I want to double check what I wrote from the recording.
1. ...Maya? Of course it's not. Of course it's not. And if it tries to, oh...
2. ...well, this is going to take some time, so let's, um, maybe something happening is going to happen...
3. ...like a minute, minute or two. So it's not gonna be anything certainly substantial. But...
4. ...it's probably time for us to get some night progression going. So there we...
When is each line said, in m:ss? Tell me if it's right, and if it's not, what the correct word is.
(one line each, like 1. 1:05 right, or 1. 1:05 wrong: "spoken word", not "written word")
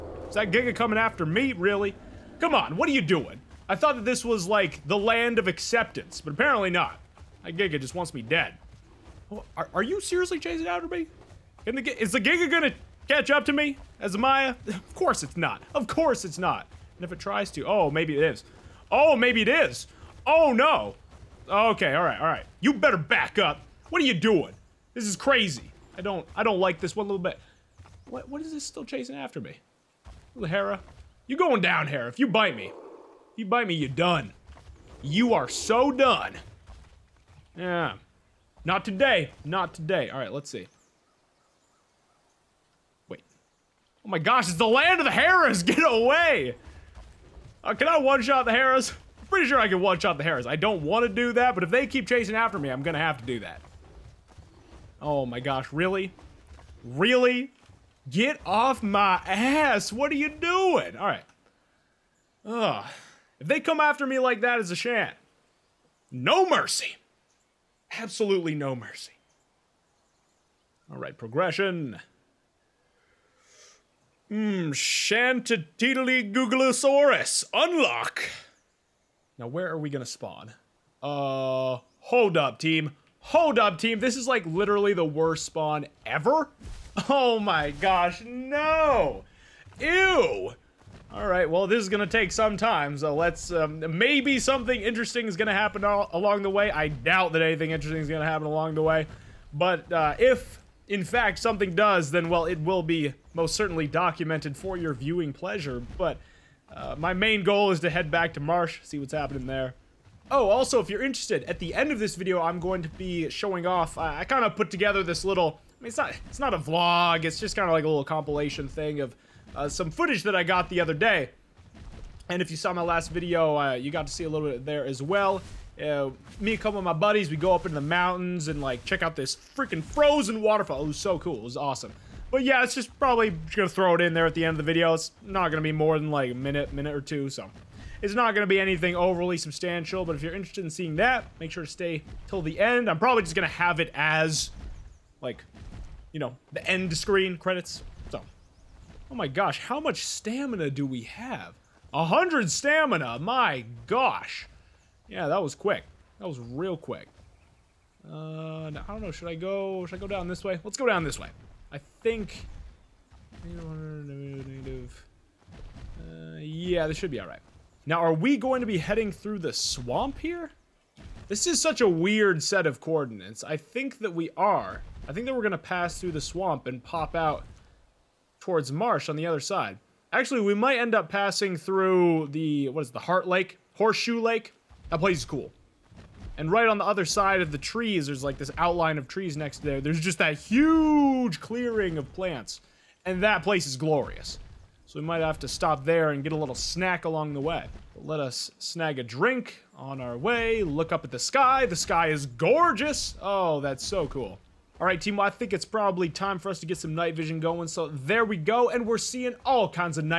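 1. 0:14 right
2. 1:31 wrong: "interesting", not "happening"
3. 2:16 wrong: "overly", not "certainly"
4. 3:25 wrong: "vision", not "progression".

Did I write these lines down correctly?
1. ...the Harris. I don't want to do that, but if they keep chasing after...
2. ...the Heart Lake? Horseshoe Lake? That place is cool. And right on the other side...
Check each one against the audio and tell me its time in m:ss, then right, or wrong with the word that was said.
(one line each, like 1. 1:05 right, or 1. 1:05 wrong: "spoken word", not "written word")
1. 0:50 right
2. 3:02 right.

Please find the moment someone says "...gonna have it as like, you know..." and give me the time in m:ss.
2:23.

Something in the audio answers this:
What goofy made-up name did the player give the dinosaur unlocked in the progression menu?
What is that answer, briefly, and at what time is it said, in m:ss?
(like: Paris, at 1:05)
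Shantatiddly Googlosaurus, at 1:14.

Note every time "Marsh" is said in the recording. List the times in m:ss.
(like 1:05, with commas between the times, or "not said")
1:48, 2:58.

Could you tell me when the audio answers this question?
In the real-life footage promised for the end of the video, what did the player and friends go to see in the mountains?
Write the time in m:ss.
2:09.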